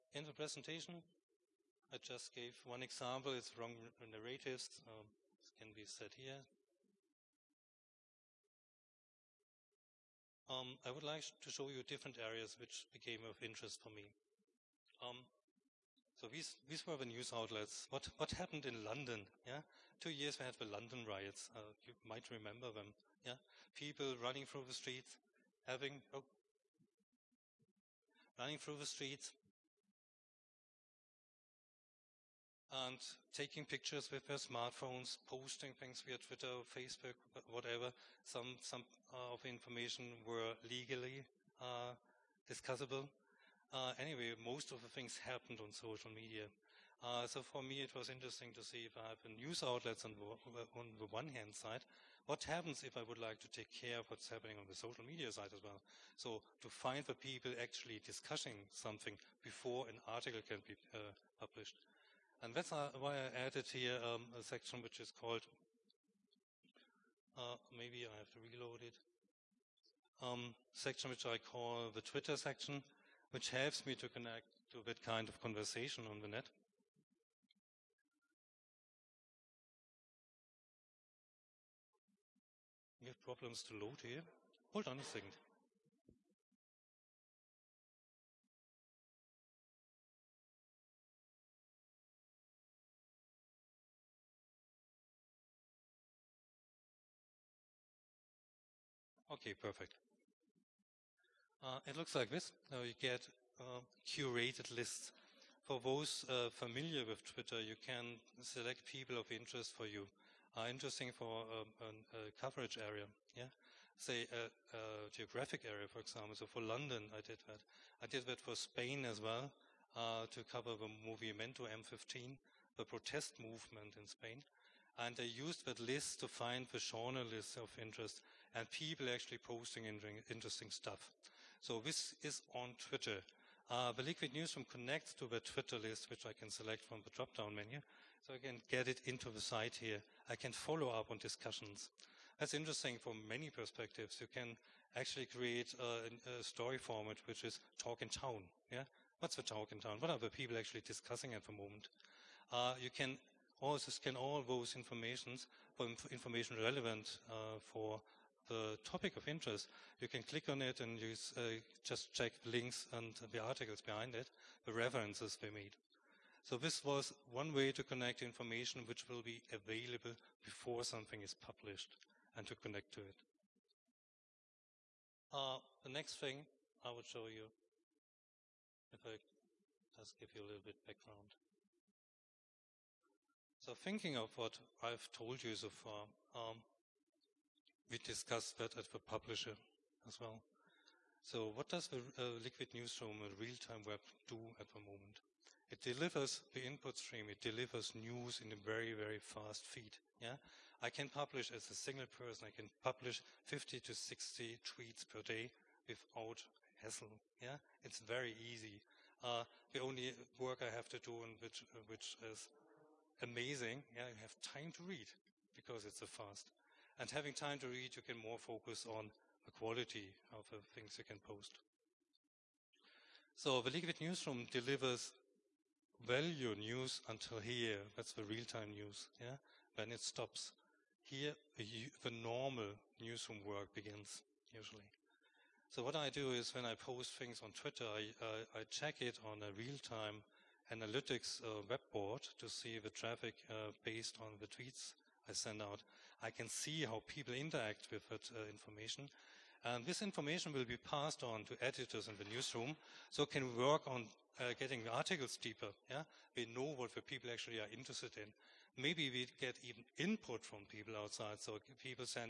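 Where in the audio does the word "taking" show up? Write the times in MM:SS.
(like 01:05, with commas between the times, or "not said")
00:33.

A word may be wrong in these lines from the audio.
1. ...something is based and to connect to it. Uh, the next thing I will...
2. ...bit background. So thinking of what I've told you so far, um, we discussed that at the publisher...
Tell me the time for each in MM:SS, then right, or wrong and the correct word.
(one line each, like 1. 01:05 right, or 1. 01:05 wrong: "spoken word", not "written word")
1. 02:50 wrong: "published", not "based"
2. 03:00 right.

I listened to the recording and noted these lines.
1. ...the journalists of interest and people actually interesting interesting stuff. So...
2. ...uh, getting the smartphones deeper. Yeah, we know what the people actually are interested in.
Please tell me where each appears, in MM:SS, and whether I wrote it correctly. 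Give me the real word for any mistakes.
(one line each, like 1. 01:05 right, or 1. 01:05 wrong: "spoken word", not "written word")
1. 02:06 wrong: "posting", not "interesting"
2. 04:14 wrong: "articles", not "smartphones".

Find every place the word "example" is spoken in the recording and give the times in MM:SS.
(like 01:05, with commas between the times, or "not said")
00:02, 01:55.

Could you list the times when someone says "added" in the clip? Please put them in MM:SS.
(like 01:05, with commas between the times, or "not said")
01:03.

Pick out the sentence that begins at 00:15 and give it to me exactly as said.
Um, so these, these were the news outlets.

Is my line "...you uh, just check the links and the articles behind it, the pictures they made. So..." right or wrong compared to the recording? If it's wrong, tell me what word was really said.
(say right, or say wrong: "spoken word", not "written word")
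wrong: "references", not "pictures".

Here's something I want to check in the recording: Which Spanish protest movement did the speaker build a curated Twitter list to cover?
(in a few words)
Movimiento M15.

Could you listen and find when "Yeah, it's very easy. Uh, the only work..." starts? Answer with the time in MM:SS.
03:27.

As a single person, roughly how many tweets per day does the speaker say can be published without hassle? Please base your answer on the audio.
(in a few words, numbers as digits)
50 to 60.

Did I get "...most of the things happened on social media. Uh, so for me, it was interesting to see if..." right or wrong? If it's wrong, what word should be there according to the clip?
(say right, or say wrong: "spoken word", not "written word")
right.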